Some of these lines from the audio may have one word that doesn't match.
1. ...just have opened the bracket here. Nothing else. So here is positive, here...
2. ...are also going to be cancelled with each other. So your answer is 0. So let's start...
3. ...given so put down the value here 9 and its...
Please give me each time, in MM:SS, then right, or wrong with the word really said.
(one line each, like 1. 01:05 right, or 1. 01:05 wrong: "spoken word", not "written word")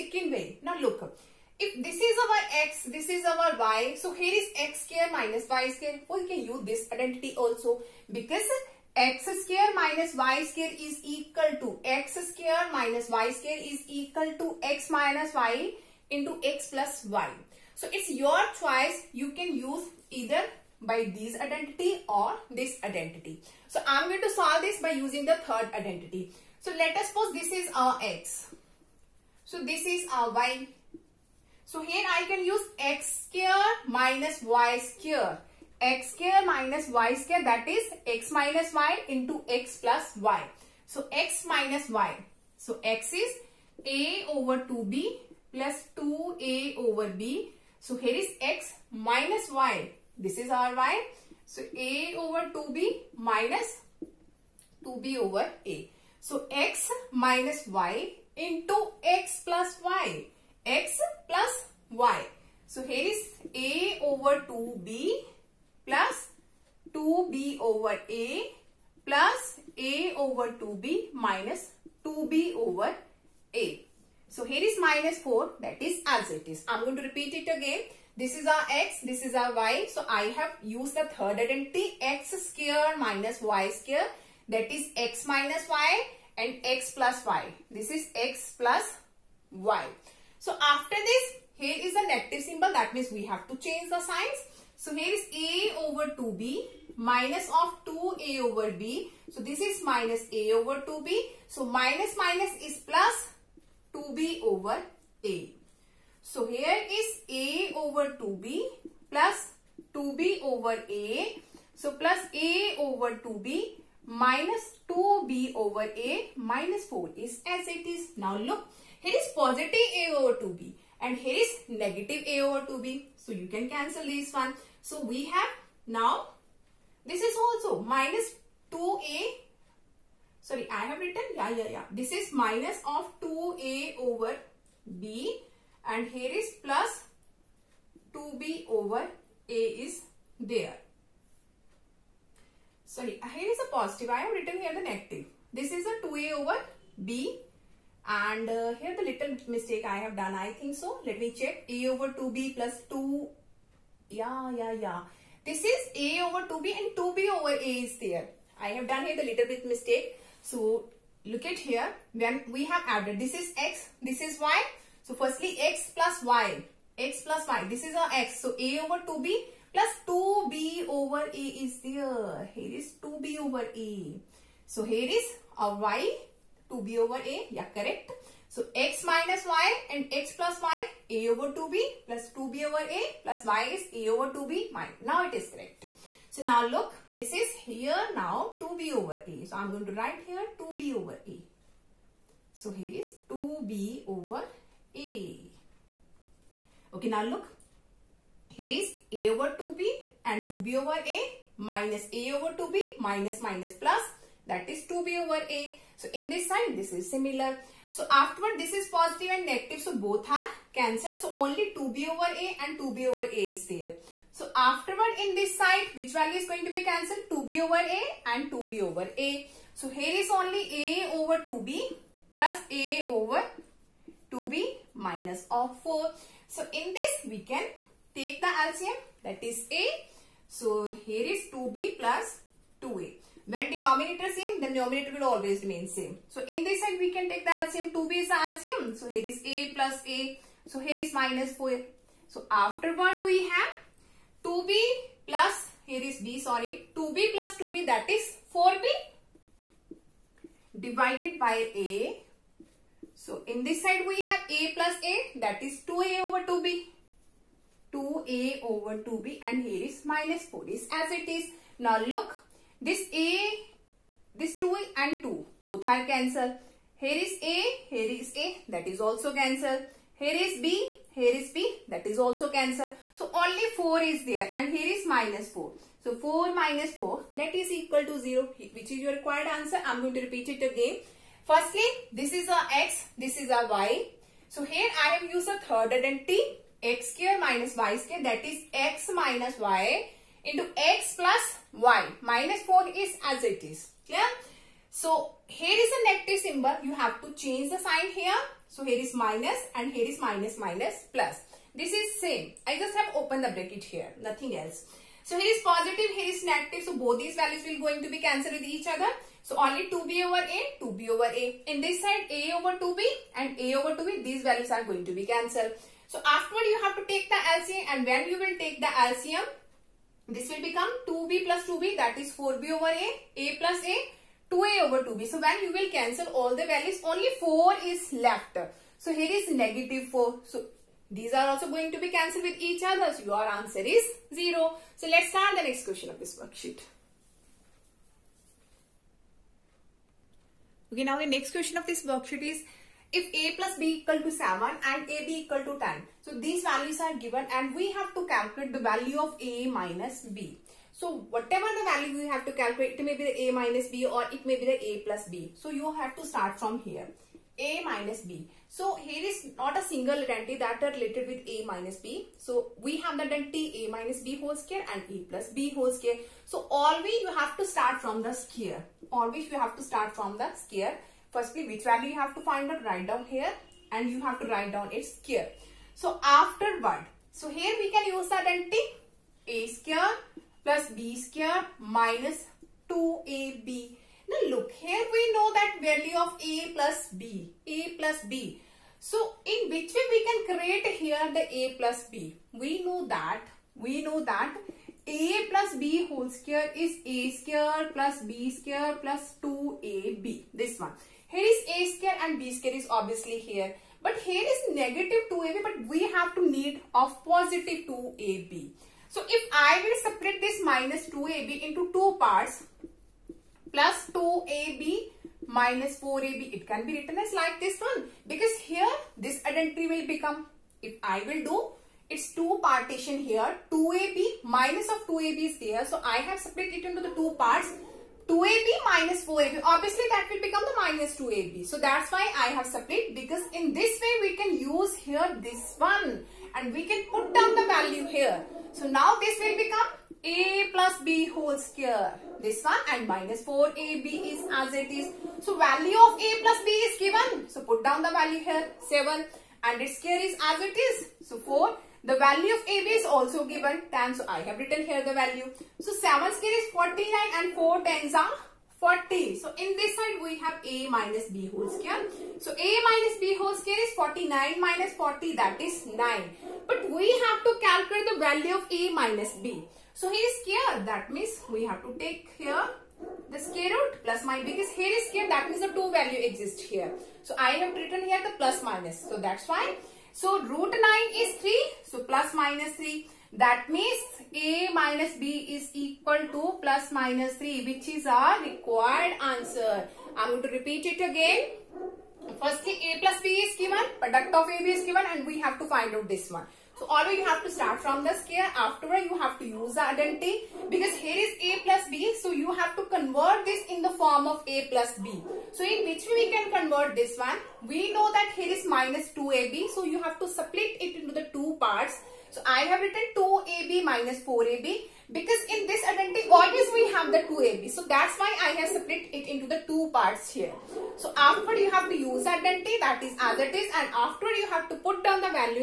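1. 05:02 right
2. 05:31 right
3. 07:27 wrong: "7", not "9".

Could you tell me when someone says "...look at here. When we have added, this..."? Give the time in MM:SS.
02:41.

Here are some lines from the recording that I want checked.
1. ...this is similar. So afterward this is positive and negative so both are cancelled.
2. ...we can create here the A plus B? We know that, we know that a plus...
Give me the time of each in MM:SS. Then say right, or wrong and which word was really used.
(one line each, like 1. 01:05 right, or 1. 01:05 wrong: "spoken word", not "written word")
1. 03:26 right
2. 06:30 right.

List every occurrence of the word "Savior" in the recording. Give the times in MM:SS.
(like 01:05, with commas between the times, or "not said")
not said.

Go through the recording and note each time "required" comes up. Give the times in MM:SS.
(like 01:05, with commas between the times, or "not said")
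04:39, 08:08.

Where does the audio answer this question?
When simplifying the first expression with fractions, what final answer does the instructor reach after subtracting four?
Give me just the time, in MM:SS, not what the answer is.
04:36.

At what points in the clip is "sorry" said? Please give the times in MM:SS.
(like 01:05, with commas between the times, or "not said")
02:10, 02:22, 04:06.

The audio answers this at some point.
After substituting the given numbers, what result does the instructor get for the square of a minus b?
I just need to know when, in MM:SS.
07:43.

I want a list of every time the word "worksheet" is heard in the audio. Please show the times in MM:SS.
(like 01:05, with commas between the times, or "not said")
05:36, 05:42.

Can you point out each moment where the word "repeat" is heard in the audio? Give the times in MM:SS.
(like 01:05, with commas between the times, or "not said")
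01:17, 04:40, 08:10.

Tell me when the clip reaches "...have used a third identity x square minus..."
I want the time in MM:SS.
04:45.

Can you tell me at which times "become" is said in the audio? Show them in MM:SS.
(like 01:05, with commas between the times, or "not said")
05:20, 07:00, 07:10, 07:19.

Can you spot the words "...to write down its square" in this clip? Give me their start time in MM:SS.
06:14.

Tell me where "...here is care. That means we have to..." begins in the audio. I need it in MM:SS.
07:50.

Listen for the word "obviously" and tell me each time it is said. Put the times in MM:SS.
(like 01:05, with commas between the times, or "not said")
06:42, 07:09.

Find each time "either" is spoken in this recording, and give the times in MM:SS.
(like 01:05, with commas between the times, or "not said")
00:20.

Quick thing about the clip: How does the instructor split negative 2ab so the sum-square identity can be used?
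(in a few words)
2ab minus 4ab.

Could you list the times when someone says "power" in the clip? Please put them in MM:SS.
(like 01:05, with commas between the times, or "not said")
not said.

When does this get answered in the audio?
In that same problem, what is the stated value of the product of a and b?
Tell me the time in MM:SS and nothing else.
05:45.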